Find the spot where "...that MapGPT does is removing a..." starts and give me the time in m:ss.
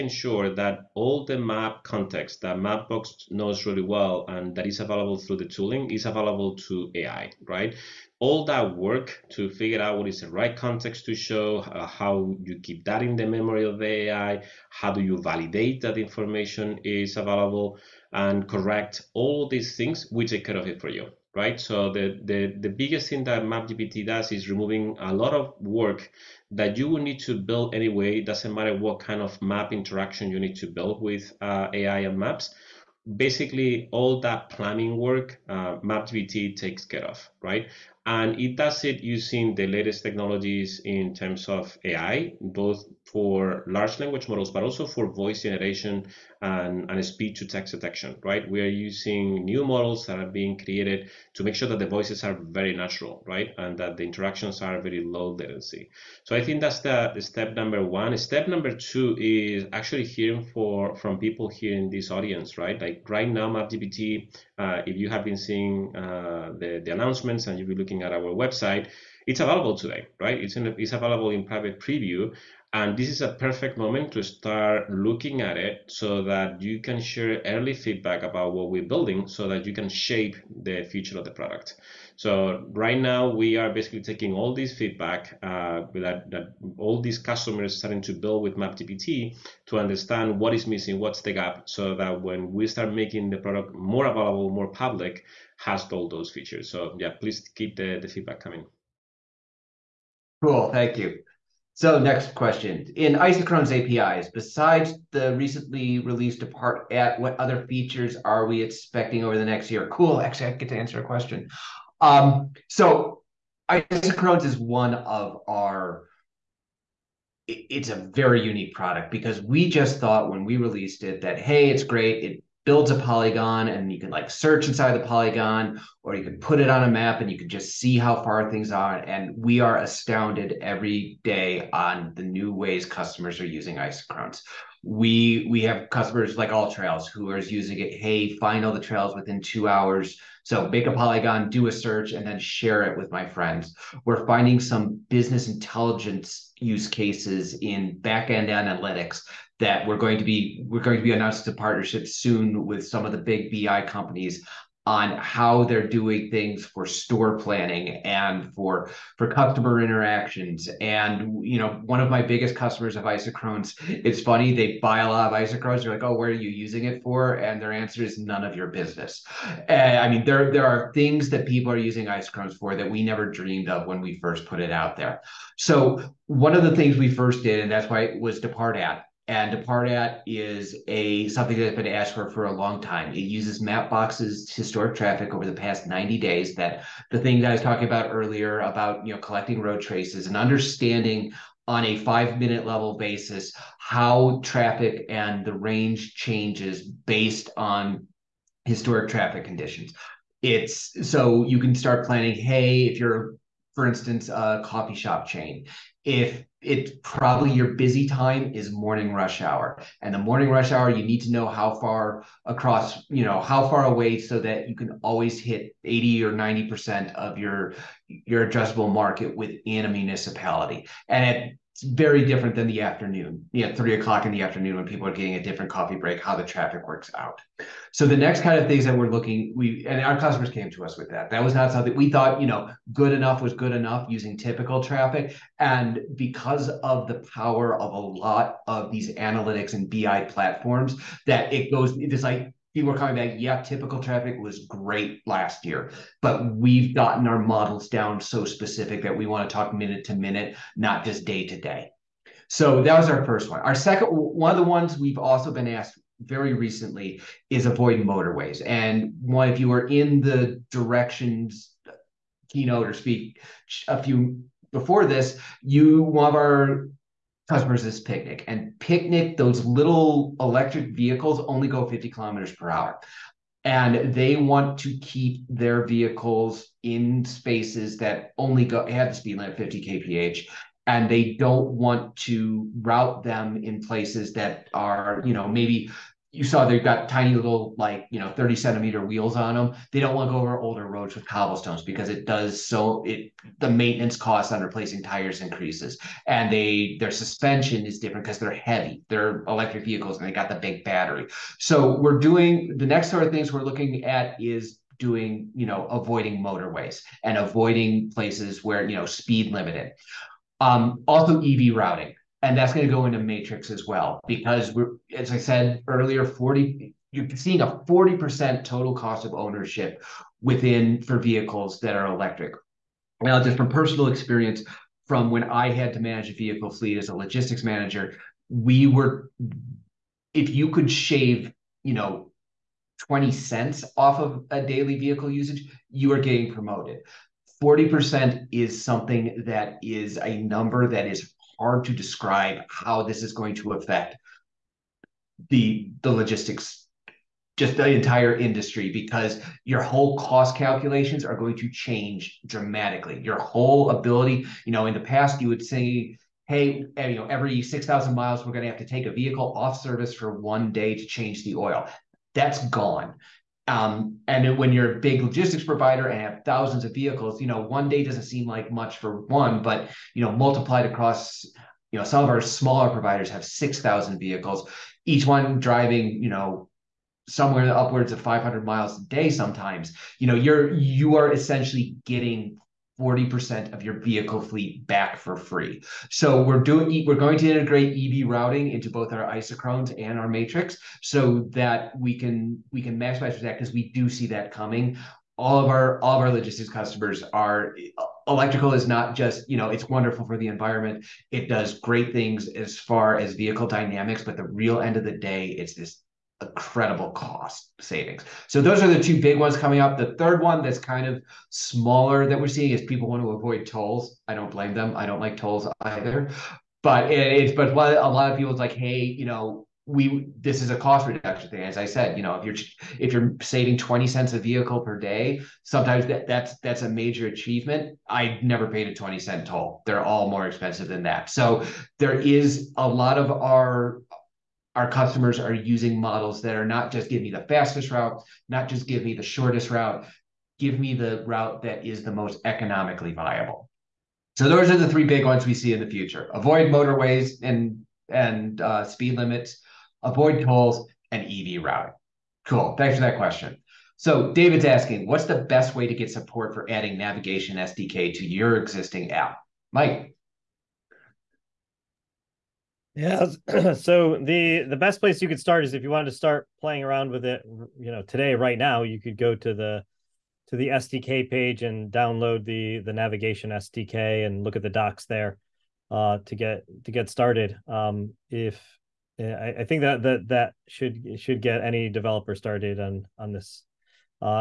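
0:23.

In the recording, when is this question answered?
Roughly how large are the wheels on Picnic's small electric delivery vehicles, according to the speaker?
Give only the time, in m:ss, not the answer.
4:48.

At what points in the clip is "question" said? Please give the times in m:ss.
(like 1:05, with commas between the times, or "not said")
1:42, 1:51, 7:33.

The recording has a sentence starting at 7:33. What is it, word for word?
So David's asking, what's the best way to get support for adding navigation SDK to your existing app?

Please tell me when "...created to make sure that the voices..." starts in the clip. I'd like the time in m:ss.
0:50.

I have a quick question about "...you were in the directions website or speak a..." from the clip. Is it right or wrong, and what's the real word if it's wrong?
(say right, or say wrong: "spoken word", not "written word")
wrong: "keynote", not "website".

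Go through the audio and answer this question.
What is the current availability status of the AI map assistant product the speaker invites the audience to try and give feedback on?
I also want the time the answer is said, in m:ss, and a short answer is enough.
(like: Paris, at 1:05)
private preview, at 1:11.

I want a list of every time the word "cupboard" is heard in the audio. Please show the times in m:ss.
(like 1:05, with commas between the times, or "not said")
not said.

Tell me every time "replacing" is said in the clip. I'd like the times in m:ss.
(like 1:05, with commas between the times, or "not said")
4:54.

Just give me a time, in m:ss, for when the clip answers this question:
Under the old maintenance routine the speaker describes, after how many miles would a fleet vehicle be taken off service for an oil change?
5:57.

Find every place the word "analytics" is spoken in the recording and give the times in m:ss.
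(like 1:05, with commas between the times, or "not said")
2:28, 3:59.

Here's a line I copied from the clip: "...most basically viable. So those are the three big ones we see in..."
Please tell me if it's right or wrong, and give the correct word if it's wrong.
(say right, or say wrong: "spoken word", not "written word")
wrong: "economically", not "basically".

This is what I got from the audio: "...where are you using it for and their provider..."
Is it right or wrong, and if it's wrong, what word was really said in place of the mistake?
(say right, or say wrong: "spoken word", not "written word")
wrong: "answer", not "provider".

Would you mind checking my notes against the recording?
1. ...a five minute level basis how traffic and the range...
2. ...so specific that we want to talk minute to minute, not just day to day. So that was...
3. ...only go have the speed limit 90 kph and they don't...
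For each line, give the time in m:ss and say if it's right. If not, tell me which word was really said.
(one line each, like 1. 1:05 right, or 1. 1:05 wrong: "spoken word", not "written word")
1. 3:11 right
2. 4:08 right
3. 4:38 wrong: "50", not "90".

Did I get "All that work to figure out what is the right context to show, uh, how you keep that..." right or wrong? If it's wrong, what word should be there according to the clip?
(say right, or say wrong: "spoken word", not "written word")
right.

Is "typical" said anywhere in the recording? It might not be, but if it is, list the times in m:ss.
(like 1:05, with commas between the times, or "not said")
3:54, 4:03.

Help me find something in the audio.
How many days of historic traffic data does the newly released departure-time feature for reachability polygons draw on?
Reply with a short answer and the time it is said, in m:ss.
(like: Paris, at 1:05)
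90, at 3:05.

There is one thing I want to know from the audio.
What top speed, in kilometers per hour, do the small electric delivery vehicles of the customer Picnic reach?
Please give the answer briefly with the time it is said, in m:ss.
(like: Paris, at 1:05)
50, at 4:31.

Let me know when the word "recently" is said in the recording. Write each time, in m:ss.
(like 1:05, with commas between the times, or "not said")
1:45, 4:16.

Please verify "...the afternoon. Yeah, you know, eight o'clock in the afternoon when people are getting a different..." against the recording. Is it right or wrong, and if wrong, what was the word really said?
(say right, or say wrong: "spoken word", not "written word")
wrong: "three", not "eight".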